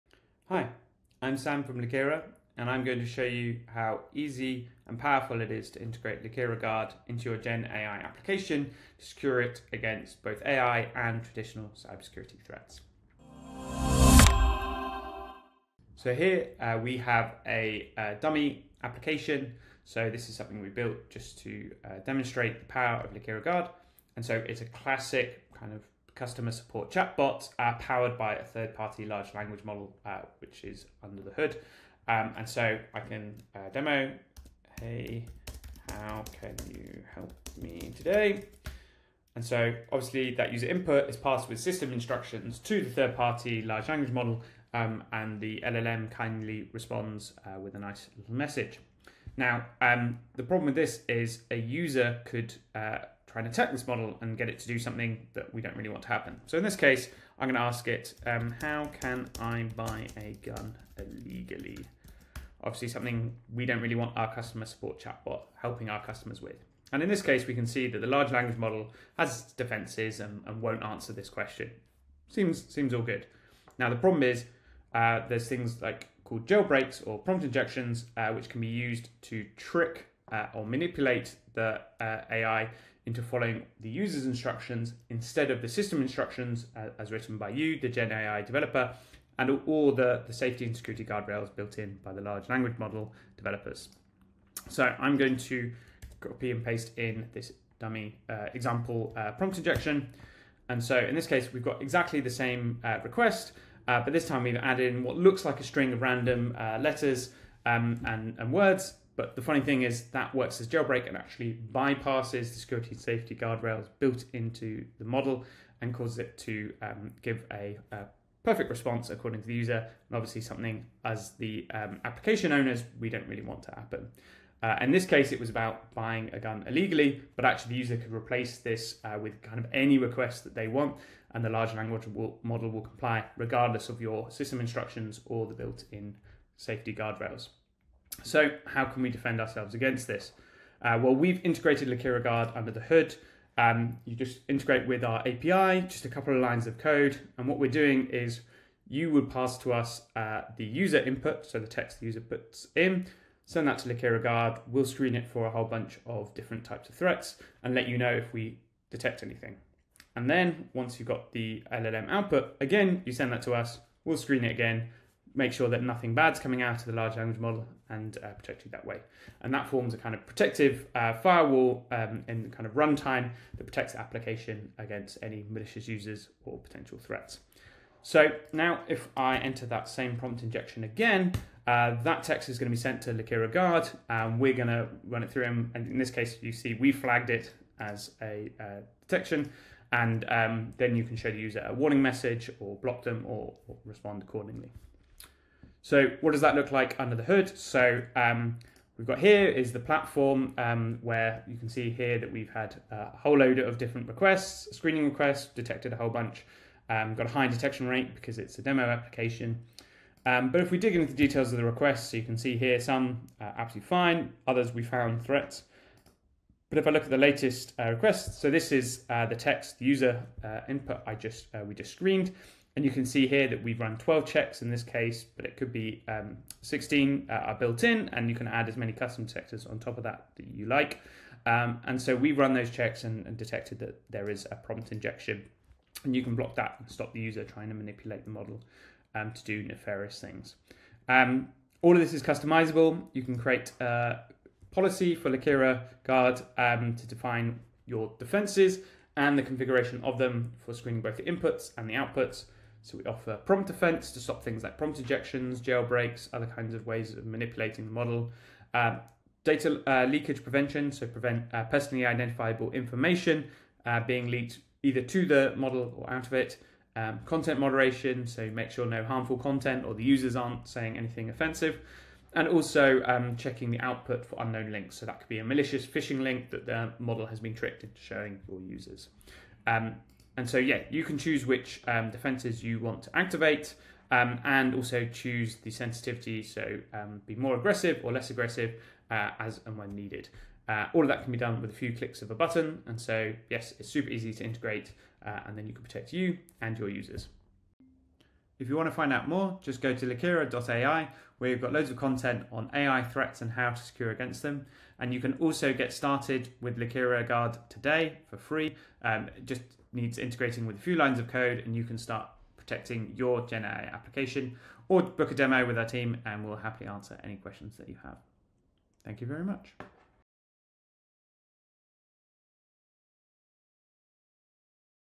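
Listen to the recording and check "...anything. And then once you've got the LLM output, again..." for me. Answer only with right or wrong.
right.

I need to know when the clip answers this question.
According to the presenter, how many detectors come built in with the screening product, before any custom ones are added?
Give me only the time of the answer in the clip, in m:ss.
3:46.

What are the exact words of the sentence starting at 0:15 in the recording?
So here uh, we have a, a, dummy application.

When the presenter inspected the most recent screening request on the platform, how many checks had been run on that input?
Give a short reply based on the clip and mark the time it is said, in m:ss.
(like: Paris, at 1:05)
12, at 3:43.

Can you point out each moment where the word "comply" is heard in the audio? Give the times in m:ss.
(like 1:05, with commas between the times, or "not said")
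2:12.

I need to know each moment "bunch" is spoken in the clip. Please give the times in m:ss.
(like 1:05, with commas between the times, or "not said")
2:35, 3:26.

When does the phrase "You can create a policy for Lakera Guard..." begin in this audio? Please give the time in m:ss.
4:03.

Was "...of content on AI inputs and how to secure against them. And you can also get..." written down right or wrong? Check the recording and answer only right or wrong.
wrong.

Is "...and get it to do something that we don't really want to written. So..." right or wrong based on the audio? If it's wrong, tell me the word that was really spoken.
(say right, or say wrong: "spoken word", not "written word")
wrong: "happen", not "written".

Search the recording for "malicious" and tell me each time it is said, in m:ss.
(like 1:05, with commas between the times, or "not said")
2:55, 4:35.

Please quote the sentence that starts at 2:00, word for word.
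And obviously something as the um, application owners, we don't really want to happen.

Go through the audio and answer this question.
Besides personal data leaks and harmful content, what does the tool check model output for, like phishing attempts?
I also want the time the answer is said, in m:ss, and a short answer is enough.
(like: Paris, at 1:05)
Unknown links, at 4:34.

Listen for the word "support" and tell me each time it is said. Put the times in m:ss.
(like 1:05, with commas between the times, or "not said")
0:26, 1:04.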